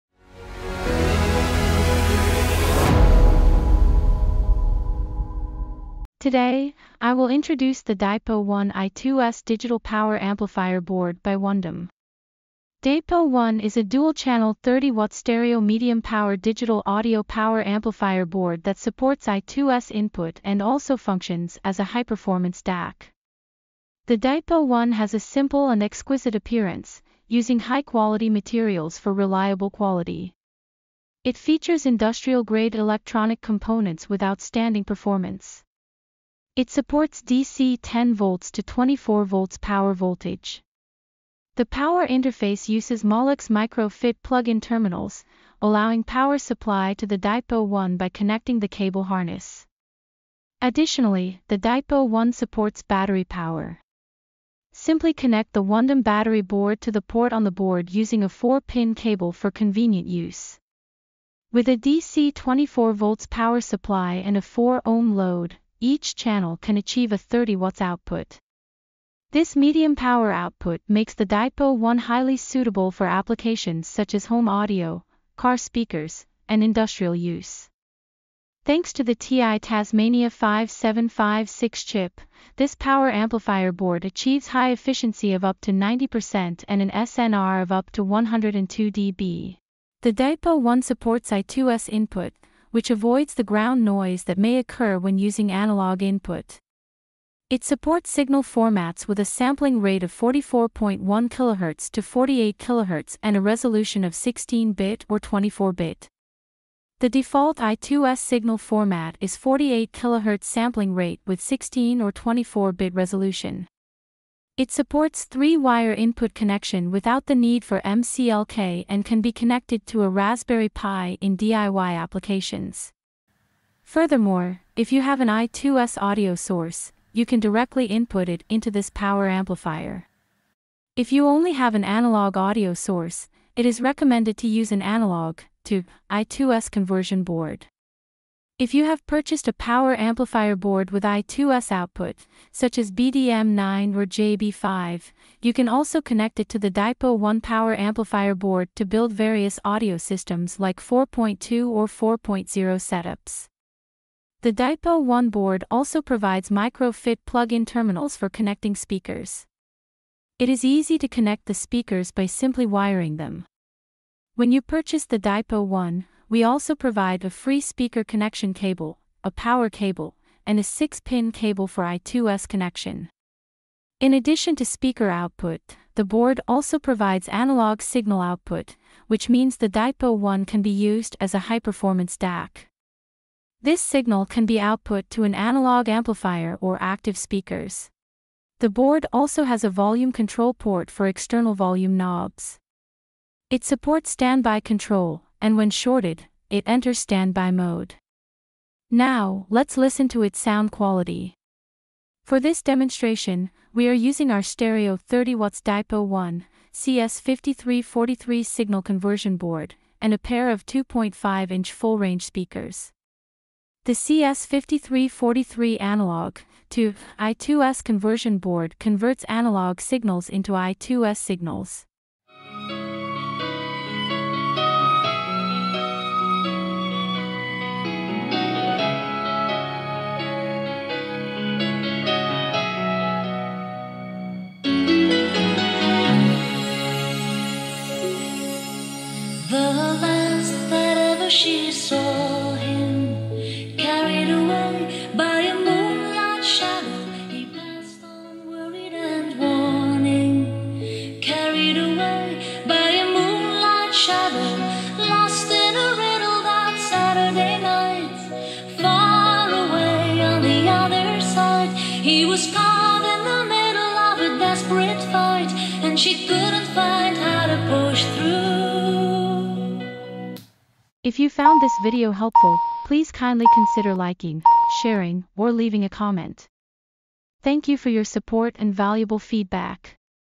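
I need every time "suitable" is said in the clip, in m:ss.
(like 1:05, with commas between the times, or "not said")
1:12.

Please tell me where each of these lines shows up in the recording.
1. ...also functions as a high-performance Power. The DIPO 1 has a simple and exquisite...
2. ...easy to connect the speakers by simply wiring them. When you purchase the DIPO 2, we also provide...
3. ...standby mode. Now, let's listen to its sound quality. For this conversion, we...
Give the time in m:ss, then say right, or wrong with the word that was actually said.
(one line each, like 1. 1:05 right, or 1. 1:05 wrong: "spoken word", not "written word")
1. 0:20 wrong: "DAC", not "Power"
2. 2:40 wrong: "1", not "2"
3. 3:16 wrong: "demonstration", not "conversion".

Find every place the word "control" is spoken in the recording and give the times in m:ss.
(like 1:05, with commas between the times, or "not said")
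3:10, 3:14.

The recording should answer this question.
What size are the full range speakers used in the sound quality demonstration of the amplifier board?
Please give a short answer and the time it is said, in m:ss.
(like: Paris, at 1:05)
2.5 inch, at 3:30.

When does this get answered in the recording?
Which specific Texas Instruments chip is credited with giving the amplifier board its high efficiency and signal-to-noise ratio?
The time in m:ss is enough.
1:19.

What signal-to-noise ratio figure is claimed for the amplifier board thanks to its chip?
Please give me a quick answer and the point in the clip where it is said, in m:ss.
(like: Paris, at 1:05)
102 dB, at 1:28.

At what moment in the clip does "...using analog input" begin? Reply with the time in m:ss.
1:35.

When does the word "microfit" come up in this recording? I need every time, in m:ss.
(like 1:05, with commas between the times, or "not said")
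0:43, 2:36.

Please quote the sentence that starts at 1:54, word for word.
It supports three-wire input connection without the need for MCLK and can be connected to a Raspberry Pi in DIY applications.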